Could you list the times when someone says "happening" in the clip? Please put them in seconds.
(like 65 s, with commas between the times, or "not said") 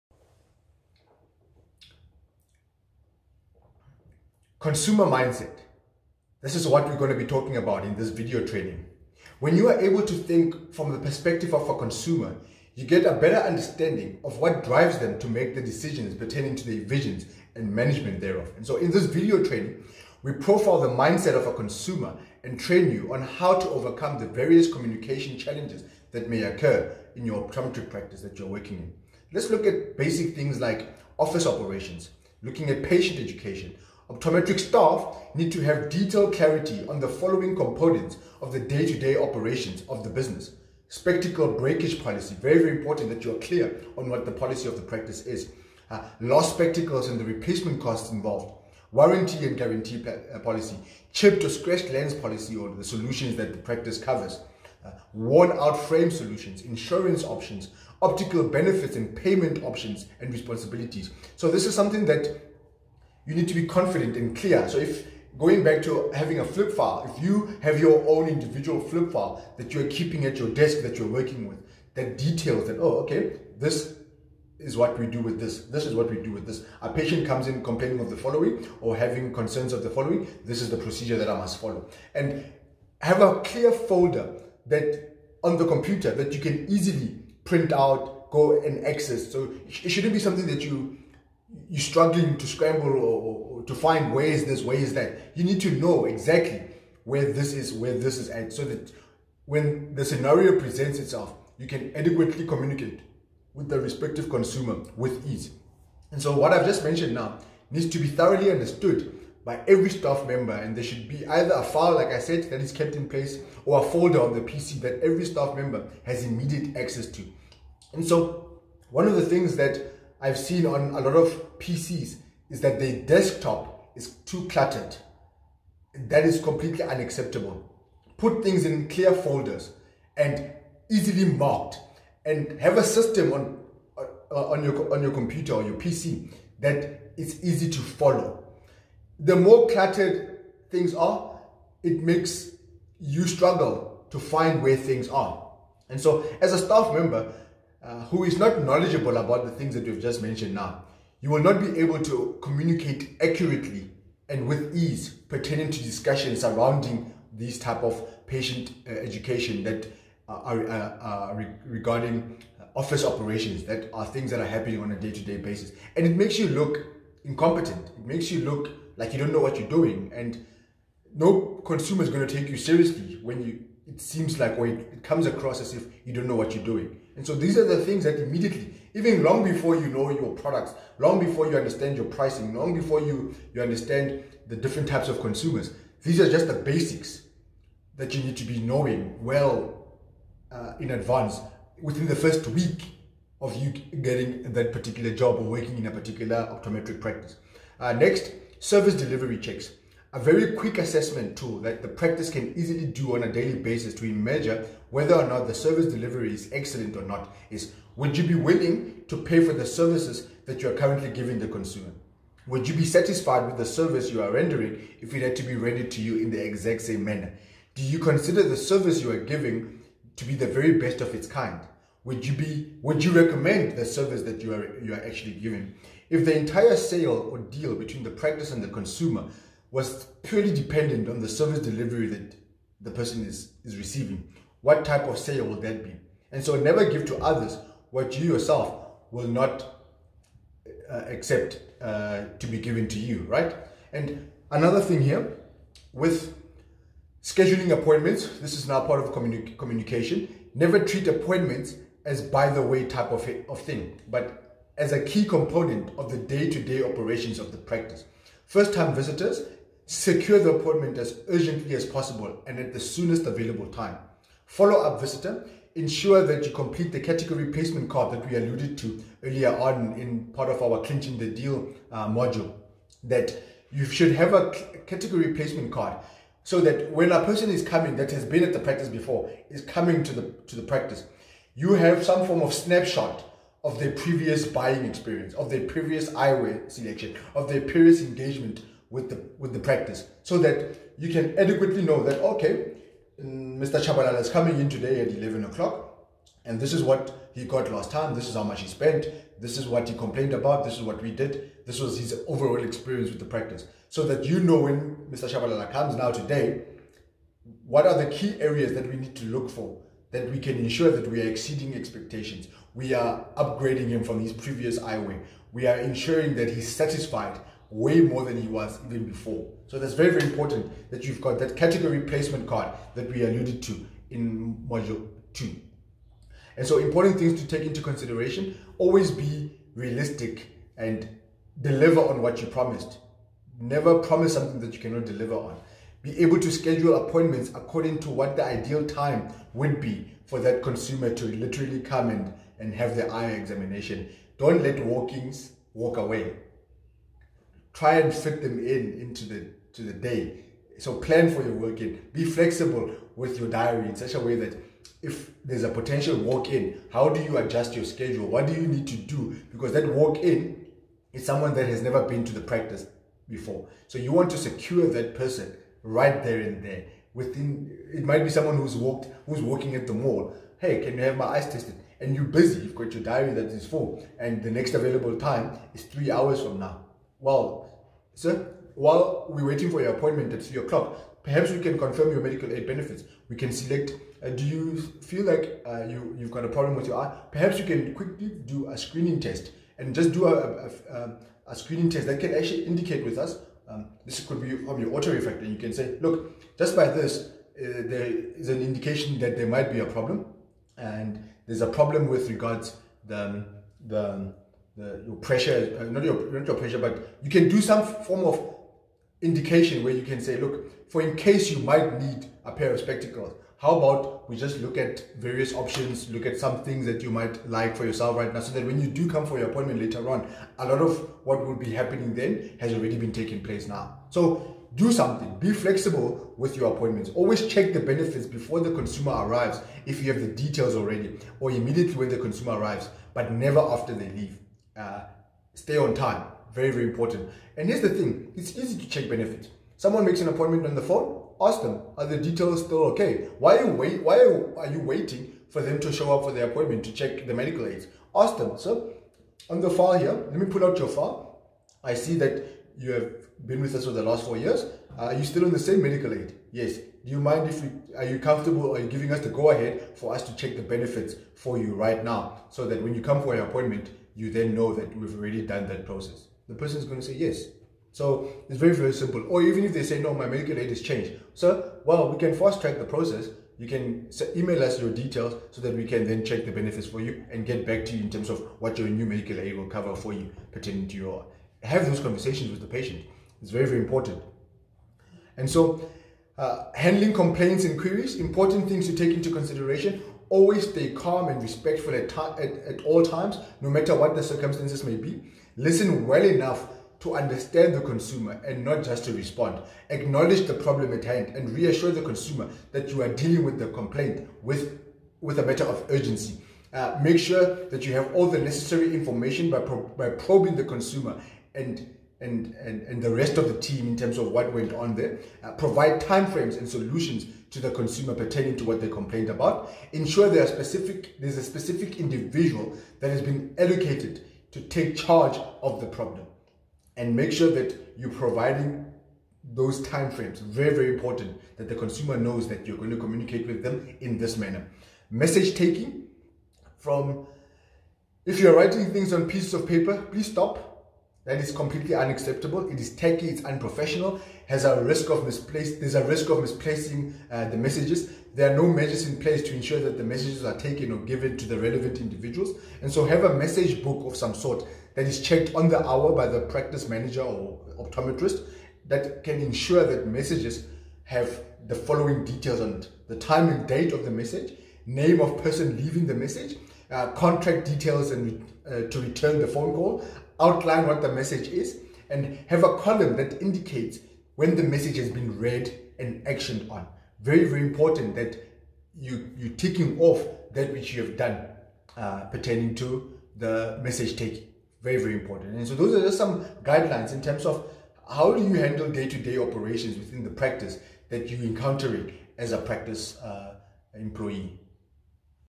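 164 s, 421 s.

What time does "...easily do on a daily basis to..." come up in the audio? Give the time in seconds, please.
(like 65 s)
202 s.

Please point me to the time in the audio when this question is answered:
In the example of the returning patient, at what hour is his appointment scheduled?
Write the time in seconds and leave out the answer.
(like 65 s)
295 s.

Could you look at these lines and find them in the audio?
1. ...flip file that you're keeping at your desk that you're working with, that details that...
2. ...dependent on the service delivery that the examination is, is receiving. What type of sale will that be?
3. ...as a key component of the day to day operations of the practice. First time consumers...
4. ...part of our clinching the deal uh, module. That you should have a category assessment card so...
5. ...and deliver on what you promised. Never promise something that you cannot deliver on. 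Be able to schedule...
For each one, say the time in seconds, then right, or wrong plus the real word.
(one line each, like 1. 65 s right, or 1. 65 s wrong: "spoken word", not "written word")
1. 68 s right
2. 230 s wrong: "person", not "examination"
3. 254 s wrong: "visitors", not "consumers"
4. 270 s wrong: "placement", not "assessment"
5. 330 s right.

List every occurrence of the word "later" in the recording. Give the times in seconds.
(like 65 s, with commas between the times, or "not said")
419 s.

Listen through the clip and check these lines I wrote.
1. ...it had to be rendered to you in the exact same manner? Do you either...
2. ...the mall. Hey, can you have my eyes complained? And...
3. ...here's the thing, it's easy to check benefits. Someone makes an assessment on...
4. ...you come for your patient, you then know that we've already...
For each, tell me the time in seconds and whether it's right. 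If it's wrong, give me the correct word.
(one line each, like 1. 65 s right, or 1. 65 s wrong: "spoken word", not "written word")
1. 215 s wrong: "consider", not "either"
2. 369 s wrong: "tested", not "complained"
3. 437 s wrong: "appointment", not "assessment"
4. 462 s wrong: "appointment", not "patient".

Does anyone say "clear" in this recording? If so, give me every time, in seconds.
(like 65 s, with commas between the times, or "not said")
43 s, 64 s, 83 s, 128 s.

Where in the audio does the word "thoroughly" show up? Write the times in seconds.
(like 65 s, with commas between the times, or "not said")
108 s.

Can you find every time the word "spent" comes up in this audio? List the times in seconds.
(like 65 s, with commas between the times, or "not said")
298 s.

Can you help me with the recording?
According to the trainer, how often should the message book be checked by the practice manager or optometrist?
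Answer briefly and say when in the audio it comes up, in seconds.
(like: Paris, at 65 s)
On the hour, at 555 s.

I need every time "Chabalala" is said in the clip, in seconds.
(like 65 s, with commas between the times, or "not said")
293 s, 305 s.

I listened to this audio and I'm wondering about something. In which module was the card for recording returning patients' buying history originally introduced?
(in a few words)
Module two.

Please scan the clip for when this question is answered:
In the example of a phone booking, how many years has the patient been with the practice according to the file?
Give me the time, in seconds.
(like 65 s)
454 s.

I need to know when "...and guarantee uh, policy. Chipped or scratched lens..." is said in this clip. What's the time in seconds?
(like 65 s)
49 s.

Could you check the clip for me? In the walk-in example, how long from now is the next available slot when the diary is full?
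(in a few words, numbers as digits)
3 hours.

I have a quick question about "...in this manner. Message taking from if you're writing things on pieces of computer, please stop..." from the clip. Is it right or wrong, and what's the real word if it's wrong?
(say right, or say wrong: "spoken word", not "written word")
wrong: "paper", not "computer".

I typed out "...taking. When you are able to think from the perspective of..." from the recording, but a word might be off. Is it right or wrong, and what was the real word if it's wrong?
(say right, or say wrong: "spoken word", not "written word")
wrong: "training", not "taking".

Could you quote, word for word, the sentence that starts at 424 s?
So do something, be flexible with your appointments.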